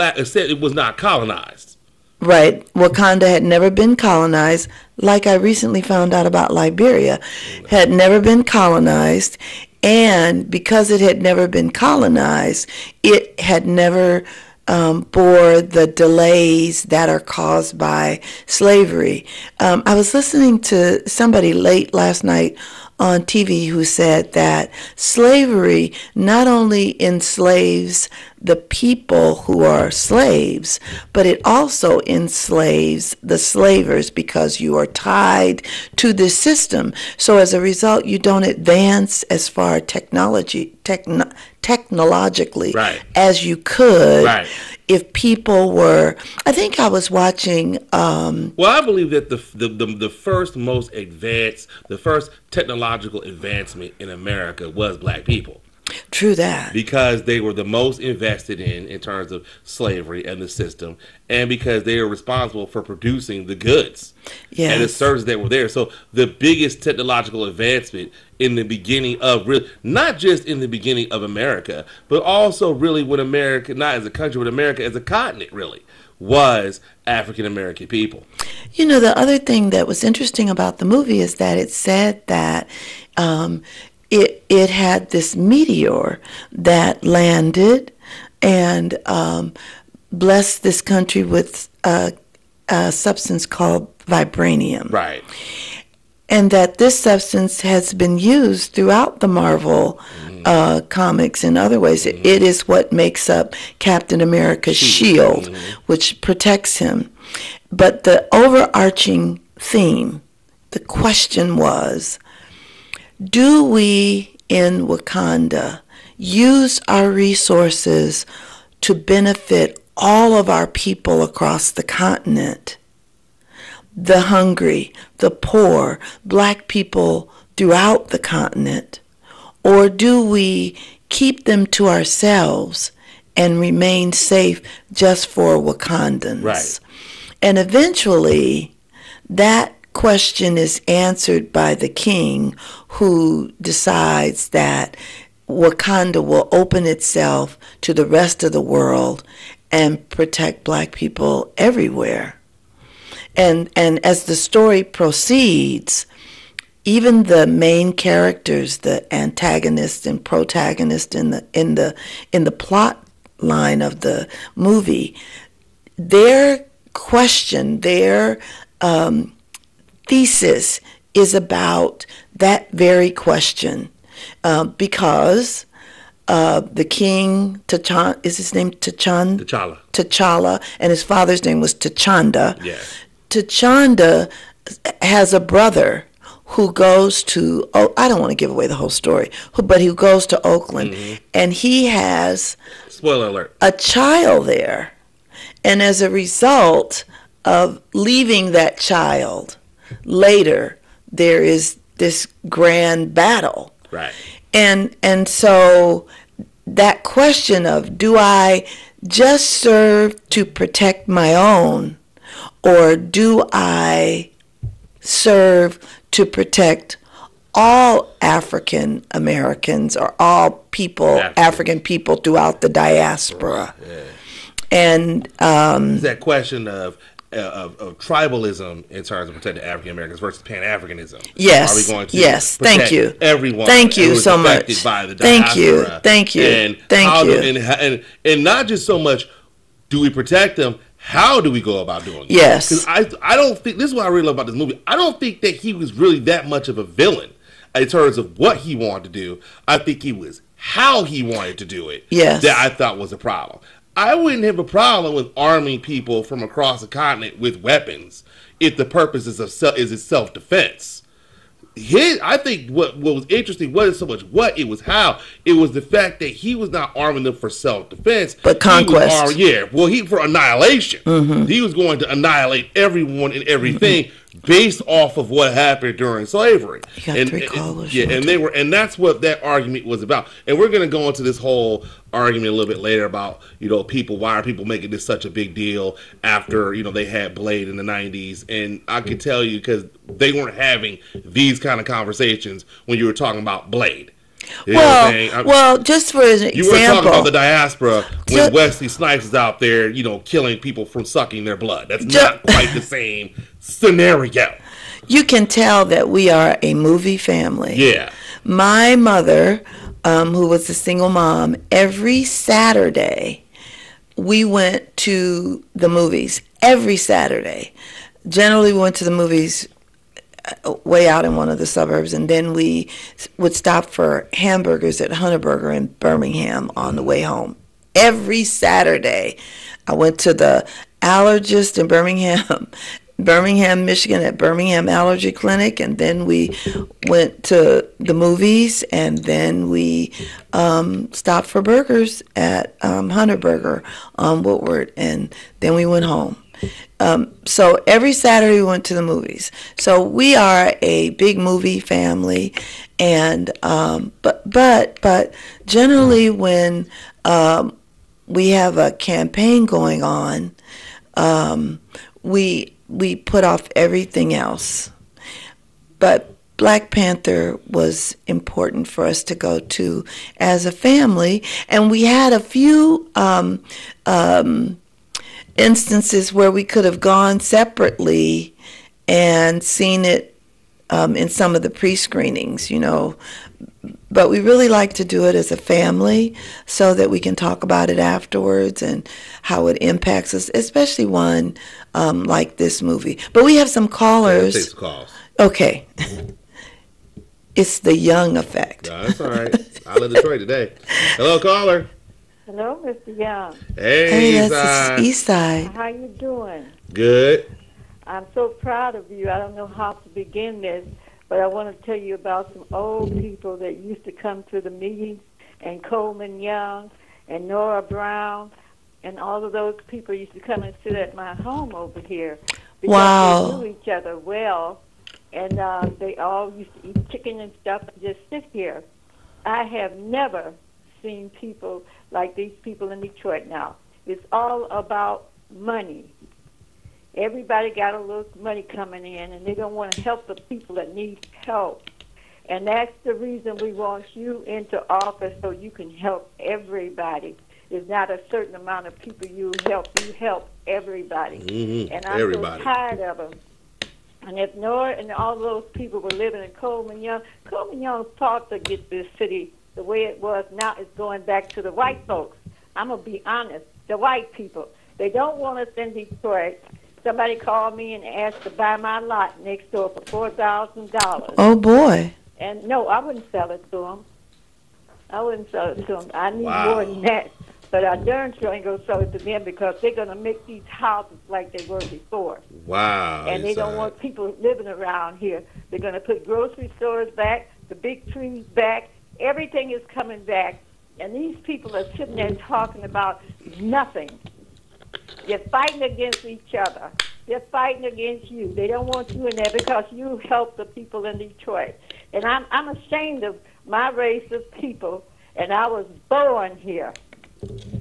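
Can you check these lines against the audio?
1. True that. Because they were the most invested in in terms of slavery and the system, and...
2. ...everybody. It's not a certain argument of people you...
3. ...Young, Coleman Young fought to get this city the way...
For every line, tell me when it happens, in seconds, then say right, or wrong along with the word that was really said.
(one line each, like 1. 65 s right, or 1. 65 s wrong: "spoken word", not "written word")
1. 56 s right
2. 446 s wrong: "amount", not "argument"
3. 457 s right.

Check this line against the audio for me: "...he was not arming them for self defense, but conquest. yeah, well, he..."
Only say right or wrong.
right.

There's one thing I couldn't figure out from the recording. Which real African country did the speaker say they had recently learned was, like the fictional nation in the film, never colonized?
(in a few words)
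Liberia.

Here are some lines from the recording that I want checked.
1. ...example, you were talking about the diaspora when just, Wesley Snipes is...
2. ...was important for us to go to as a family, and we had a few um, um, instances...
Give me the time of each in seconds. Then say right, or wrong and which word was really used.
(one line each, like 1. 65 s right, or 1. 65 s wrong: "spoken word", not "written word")
1. 296 s right
2. 367 s right.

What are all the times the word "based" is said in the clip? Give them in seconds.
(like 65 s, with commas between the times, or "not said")
274 s.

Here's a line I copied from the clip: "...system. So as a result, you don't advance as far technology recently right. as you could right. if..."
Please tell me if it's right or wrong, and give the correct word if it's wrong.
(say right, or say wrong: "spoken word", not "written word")
wrong: "technologically", not "recently".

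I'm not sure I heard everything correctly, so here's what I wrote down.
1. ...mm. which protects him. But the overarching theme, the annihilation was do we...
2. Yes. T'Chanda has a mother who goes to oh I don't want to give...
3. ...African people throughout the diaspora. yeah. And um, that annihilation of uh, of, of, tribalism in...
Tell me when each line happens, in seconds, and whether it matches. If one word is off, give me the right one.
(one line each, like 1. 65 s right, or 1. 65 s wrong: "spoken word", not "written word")
1. 105 s wrong: "question", not "annihilation"
2. 182 s wrong: "brother", not "mother"
3. 221 s wrong: "question", not "annihilation".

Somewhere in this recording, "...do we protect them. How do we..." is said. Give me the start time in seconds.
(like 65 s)
239 s.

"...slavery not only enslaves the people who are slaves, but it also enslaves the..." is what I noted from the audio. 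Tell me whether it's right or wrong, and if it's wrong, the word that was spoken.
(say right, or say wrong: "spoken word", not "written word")
right.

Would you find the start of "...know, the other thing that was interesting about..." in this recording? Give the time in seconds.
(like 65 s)
78 s.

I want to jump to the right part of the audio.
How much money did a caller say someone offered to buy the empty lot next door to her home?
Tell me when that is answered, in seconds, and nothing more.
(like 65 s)
470 s.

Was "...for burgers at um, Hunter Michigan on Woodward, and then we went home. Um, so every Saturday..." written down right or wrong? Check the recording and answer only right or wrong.
wrong.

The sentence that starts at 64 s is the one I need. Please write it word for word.
and the services that were there.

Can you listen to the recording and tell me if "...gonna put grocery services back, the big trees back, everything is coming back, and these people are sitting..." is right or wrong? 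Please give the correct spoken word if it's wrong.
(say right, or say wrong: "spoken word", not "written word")
wrong: "stores", not "services".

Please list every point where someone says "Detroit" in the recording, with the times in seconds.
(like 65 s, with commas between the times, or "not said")
400 s, 433 s, 465 s, 501 s.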